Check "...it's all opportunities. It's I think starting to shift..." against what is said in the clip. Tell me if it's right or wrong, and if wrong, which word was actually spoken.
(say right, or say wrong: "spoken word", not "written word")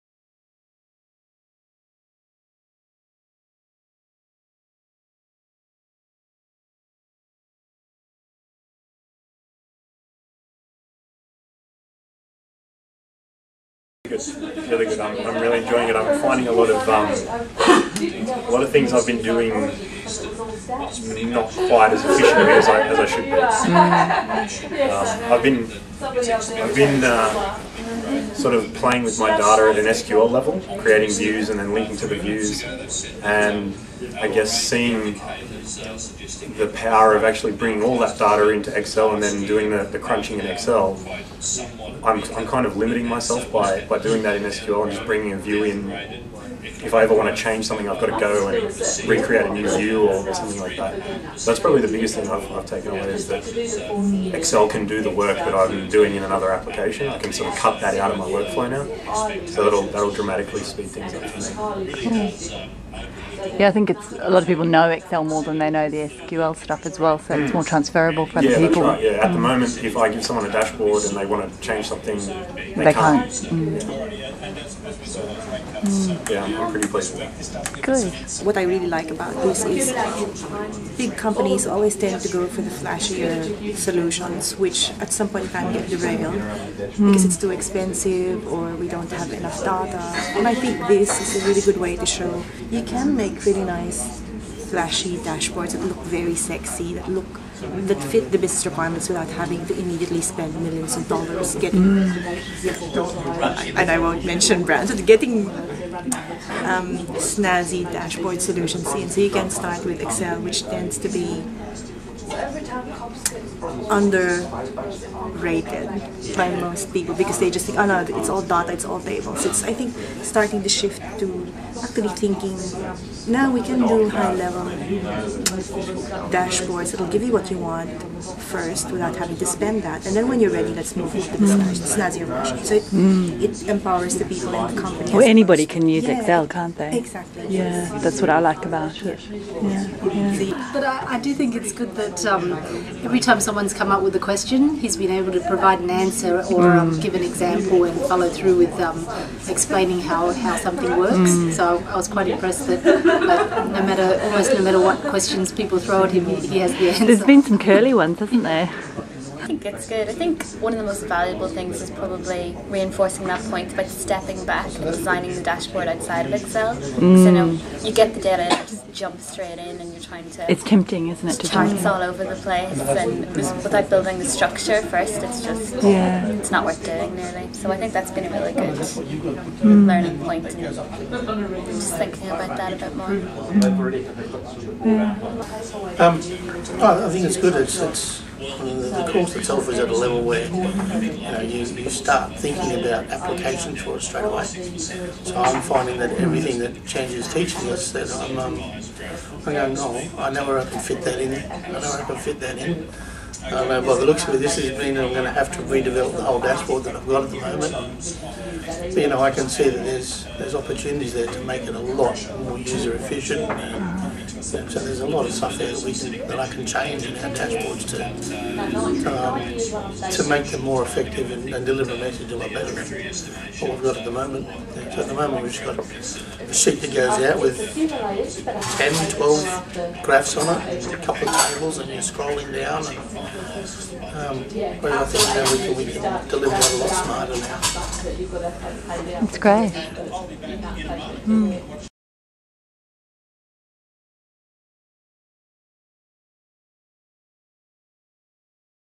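wrong: "tables", not "opportunities".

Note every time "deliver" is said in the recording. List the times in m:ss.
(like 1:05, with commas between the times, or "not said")
3:41, 3:56.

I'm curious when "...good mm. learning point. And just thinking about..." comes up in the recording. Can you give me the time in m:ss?
2:58.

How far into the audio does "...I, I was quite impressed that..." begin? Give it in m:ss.
2:31.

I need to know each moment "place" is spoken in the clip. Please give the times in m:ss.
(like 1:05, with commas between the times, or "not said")
2:52.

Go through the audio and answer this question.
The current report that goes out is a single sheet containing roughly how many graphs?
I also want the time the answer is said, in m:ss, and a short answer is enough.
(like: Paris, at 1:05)
10 to 12, at 3:48.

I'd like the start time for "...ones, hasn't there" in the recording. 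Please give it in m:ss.
2:37.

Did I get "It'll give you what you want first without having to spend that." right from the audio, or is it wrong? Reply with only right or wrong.
right.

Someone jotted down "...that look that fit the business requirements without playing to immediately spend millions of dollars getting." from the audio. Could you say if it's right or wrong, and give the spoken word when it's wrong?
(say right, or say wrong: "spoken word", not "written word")
wrong: "having", not "playing".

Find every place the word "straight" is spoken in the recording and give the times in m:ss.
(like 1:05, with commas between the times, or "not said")
2:49, 3:14.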